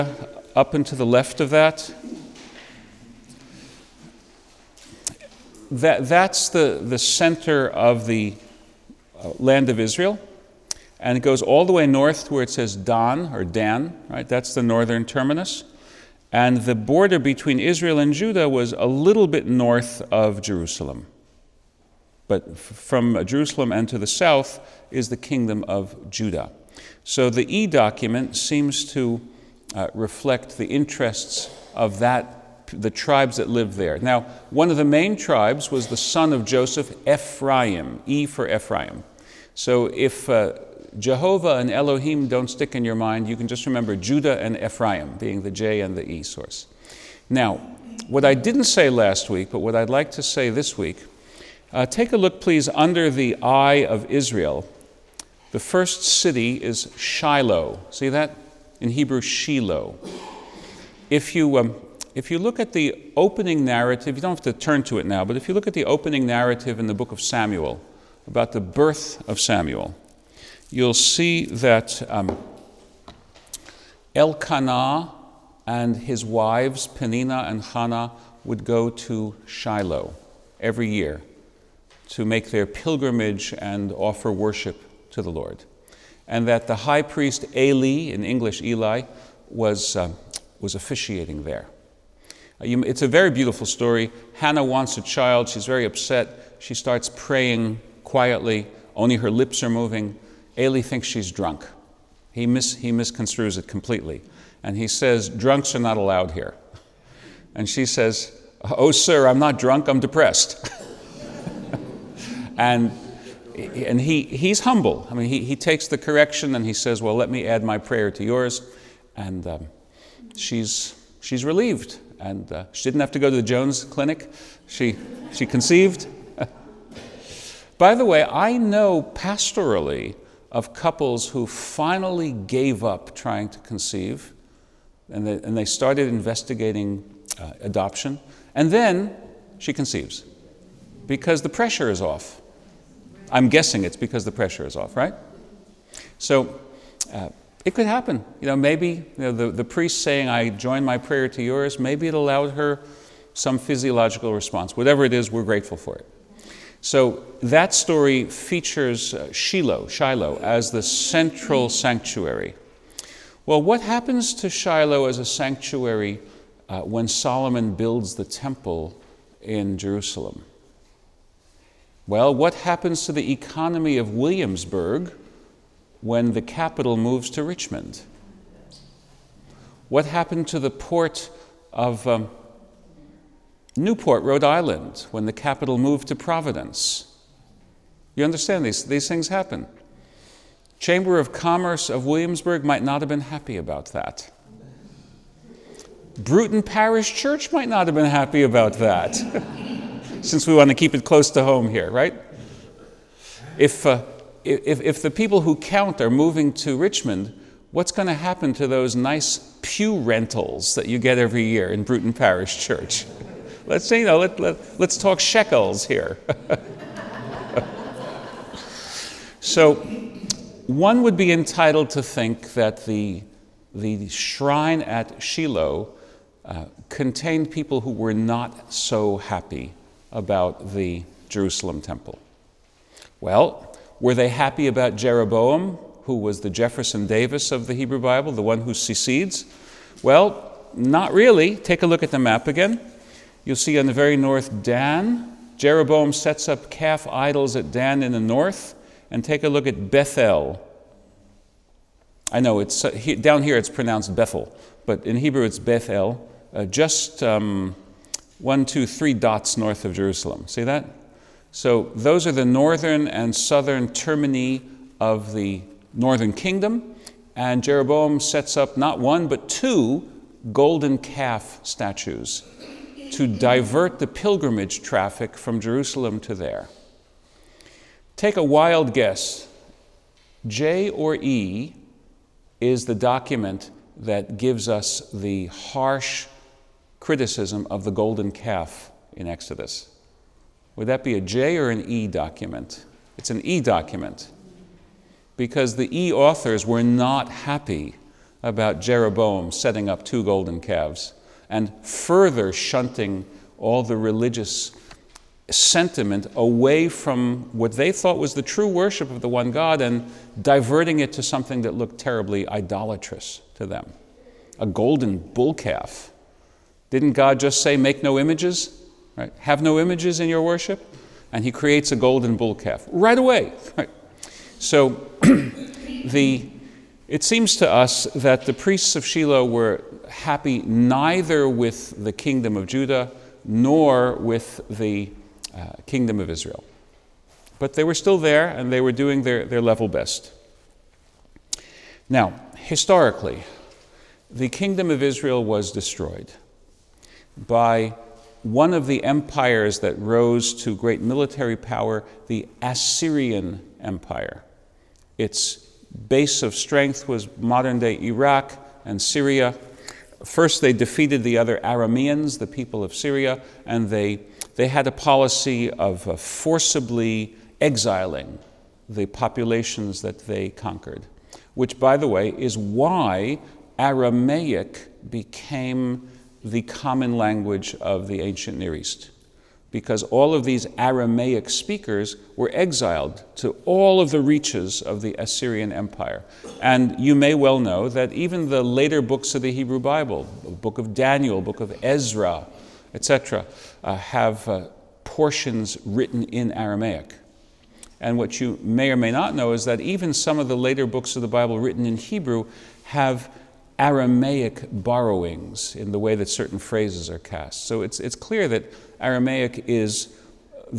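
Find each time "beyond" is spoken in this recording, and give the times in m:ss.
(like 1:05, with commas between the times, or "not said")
not said.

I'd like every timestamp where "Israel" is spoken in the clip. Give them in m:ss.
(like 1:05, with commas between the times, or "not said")
0:09, 0:17, 0:54, 5:36, 5:45.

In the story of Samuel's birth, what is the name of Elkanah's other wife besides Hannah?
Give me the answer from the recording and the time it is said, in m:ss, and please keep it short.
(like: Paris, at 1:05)
Penina, at 1:16.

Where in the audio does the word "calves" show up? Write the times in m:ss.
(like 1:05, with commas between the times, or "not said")
5:00.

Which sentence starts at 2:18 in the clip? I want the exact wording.
And then she conceives because the pressure is off.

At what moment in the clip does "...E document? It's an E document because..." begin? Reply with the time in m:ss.
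4:51.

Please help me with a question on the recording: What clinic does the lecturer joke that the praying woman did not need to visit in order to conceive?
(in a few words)
Jones Clinic.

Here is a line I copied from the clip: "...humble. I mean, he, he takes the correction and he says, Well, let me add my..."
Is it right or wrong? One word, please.
right.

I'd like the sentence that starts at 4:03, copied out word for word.
You'll see on the very north Dan.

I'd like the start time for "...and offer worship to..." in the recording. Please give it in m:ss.
1:23.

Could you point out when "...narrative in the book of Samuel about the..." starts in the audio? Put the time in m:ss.
1:06.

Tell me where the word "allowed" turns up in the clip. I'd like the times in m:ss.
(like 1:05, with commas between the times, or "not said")
1:45, 2:32.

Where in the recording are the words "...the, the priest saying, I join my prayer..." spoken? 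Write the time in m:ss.
2:29.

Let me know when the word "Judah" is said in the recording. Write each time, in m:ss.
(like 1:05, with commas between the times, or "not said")
0:18, 0:26, 0:43, 5:32.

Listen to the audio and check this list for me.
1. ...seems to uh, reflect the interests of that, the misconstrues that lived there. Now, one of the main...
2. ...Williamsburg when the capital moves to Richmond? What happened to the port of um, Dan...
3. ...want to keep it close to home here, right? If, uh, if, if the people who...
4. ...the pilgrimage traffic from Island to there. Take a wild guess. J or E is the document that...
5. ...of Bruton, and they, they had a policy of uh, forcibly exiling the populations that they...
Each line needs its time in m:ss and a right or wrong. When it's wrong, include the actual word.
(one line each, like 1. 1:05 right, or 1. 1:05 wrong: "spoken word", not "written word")
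1. 0:28 wrong: "tribes", not "misconstrues"
2. 2:54 wrong: "Newport", not "Dan"
3. 3:20 right
4. 4:33 wrong: "Jerusalem", not "Island"
5. 6:02 wrong: "Syria", not "Bruton".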